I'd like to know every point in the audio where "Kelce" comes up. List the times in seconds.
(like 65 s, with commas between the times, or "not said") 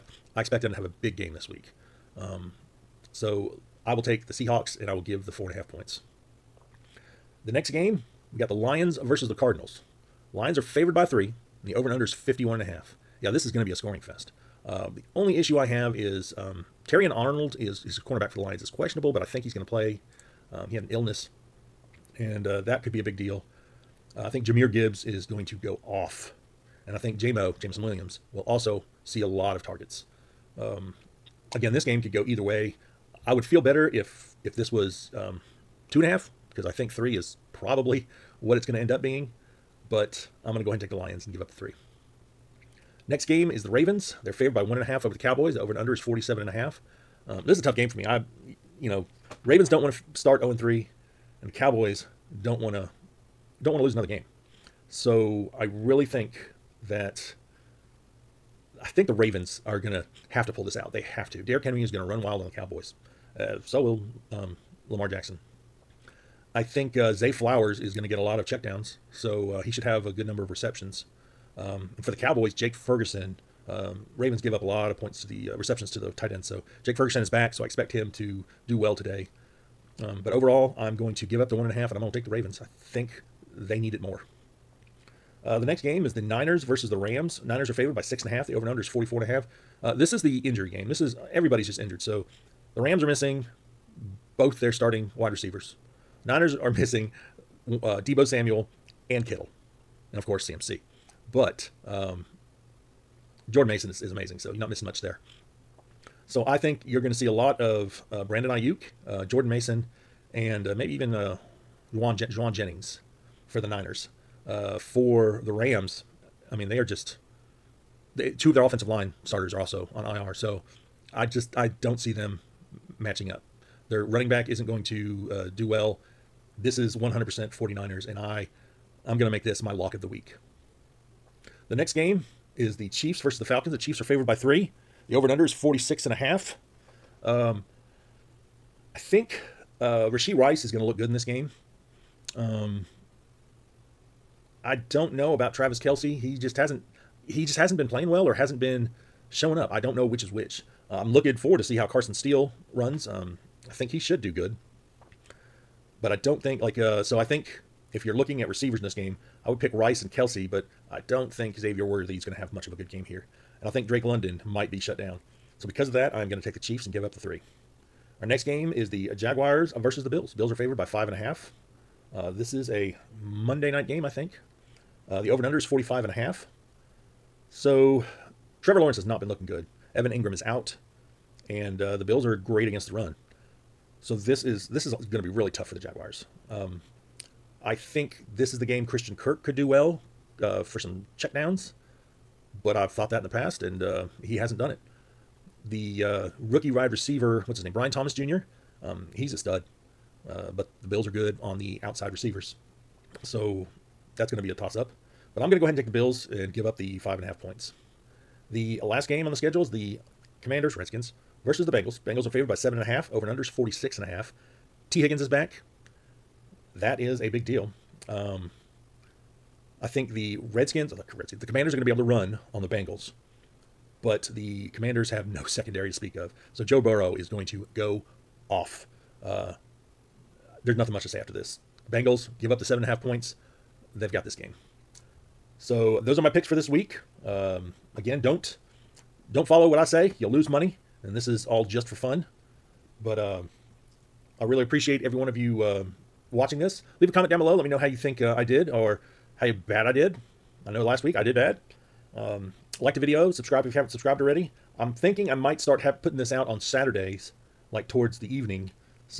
145 s, 160 s.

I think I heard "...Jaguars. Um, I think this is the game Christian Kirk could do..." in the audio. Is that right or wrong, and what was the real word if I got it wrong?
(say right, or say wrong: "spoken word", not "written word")
right.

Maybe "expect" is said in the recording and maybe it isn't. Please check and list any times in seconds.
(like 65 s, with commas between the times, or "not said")
0 s, 77 s.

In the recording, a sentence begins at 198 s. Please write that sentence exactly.
Um, he's a stud, uh, but the Bills are good on the outside receivers, so that's going to be a toss up.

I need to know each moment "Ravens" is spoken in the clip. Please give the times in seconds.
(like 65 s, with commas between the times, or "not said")
43 s, 49 s, 59 s, 74 s, 82 s.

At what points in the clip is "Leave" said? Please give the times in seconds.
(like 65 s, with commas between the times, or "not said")
247 s.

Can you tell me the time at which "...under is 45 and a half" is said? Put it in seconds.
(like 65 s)
175 s.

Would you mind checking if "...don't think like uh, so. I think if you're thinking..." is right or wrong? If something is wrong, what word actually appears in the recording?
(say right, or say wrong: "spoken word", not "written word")
wrong: "looking", not "thinking".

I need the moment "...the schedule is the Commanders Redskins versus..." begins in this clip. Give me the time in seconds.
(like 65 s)
209 s.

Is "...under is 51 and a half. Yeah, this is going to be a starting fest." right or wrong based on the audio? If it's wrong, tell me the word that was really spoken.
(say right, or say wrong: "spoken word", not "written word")
wrong: "scoring", not "starting".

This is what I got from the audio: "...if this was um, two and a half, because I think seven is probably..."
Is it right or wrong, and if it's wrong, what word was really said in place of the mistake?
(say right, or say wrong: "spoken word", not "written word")
wrong: "three", not "seven".